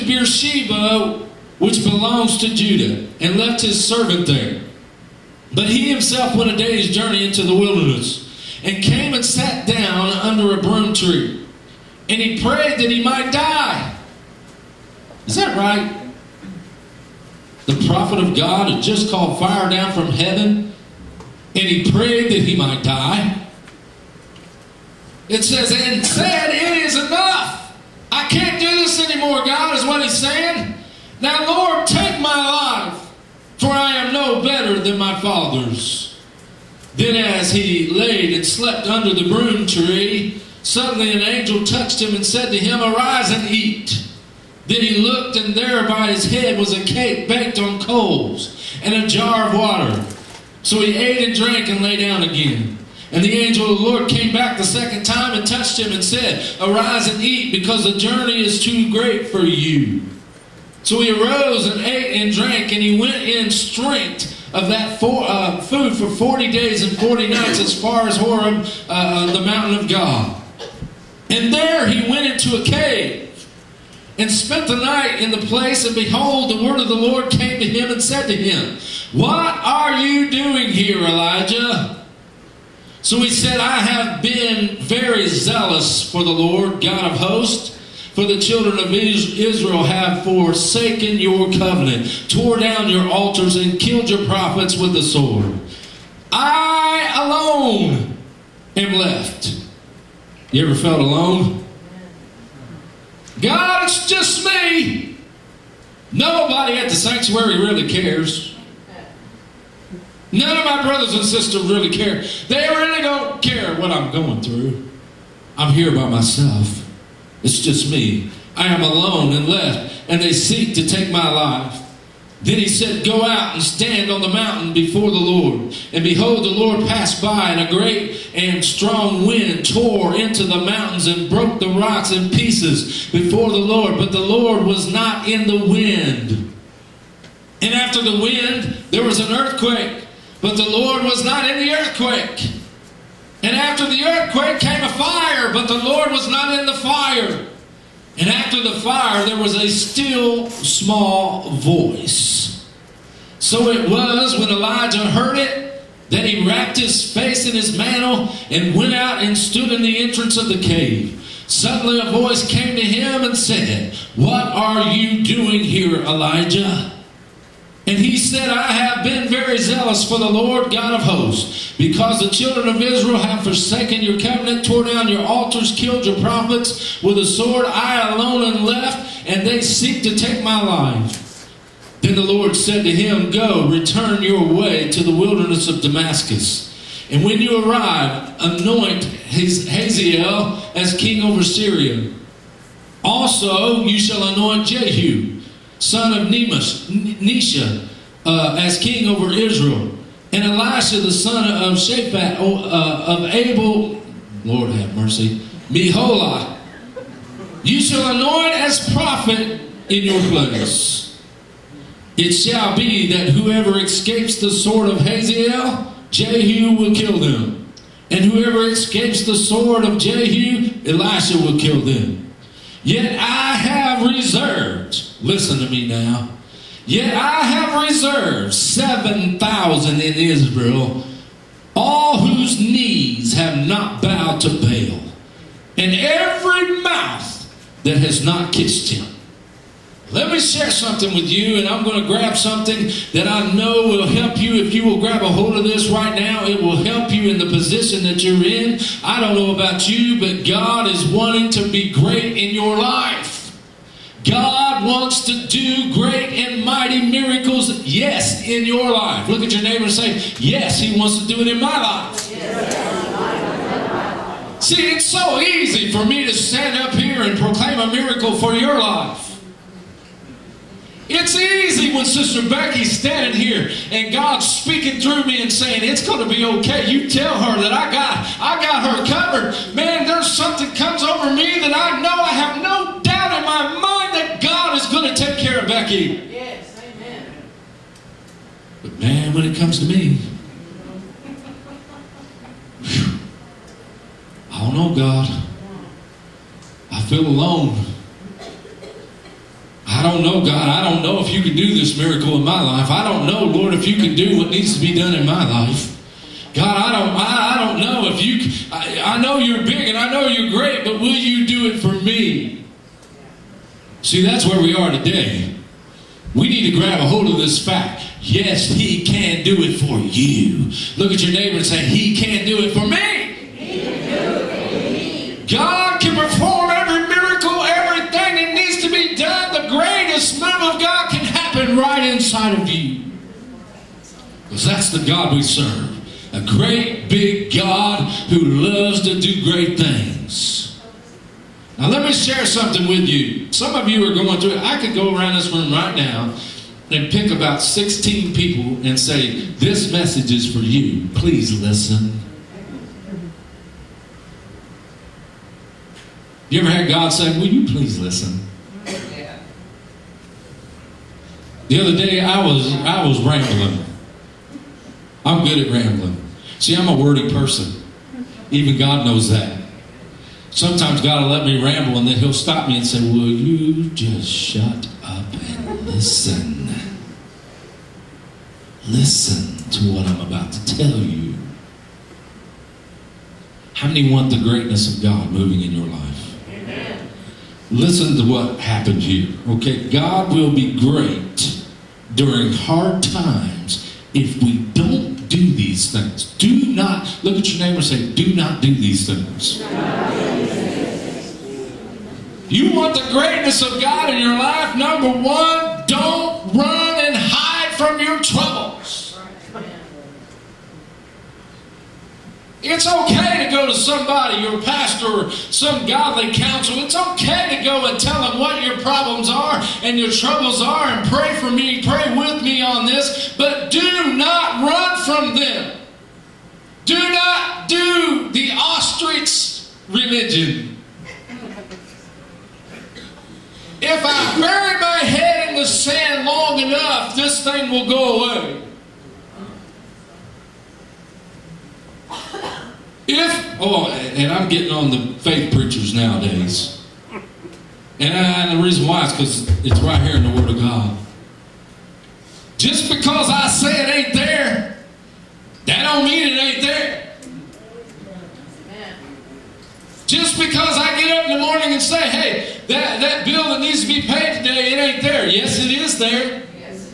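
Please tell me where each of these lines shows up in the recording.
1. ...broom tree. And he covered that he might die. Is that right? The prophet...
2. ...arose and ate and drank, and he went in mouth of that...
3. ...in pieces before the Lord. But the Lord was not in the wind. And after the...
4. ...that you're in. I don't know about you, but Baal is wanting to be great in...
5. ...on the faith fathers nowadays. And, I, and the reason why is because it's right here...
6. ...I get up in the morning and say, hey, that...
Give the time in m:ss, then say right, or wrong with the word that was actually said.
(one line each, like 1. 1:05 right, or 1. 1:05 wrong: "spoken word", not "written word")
1. 0:10 wrong: "prayed", not "covered"
2. 1:01 wrong: "strength", not "mouth"
3. 2:12 right
4. 4:08 wrong: "God", not "Baal"
5. 7:24 wrong: "preachers", not "fathers"
6. 7:40 right.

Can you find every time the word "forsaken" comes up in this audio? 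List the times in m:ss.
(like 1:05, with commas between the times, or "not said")
1:30, 2:53.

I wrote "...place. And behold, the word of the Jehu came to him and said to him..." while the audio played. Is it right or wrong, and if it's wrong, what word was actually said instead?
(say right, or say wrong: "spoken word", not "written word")
wrong: "Lord", not "Jehu".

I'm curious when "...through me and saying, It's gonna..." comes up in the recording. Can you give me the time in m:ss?
4:34.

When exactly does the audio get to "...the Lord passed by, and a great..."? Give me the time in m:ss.
2:06.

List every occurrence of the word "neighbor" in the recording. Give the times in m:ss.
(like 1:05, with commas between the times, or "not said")
4:19, 5:21, 6:37.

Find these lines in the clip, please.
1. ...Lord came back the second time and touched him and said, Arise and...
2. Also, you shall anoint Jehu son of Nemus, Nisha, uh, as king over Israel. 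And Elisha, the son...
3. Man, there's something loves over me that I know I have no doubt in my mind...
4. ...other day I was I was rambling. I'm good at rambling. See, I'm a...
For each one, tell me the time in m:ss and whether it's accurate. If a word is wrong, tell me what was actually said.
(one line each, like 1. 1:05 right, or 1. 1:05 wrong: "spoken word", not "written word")
1. 0:53 right
2. 3:13 right
3. 4:39 wrong: "comes", not "loves"
4. 6:01 right.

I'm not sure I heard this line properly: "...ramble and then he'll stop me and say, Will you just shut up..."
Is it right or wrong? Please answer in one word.
right.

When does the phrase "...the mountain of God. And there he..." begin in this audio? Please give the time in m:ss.
1:09.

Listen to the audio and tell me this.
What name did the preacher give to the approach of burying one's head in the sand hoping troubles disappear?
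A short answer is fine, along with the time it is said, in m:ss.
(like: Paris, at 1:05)
Ostrich religion, at 7:08.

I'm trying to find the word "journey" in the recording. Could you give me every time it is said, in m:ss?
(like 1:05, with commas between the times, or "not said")
0:06, 0:57.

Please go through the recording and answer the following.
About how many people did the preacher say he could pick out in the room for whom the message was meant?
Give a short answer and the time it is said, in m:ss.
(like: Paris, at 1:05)
16, at 5:47.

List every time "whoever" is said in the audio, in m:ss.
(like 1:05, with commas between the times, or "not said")
3:33, 3:38.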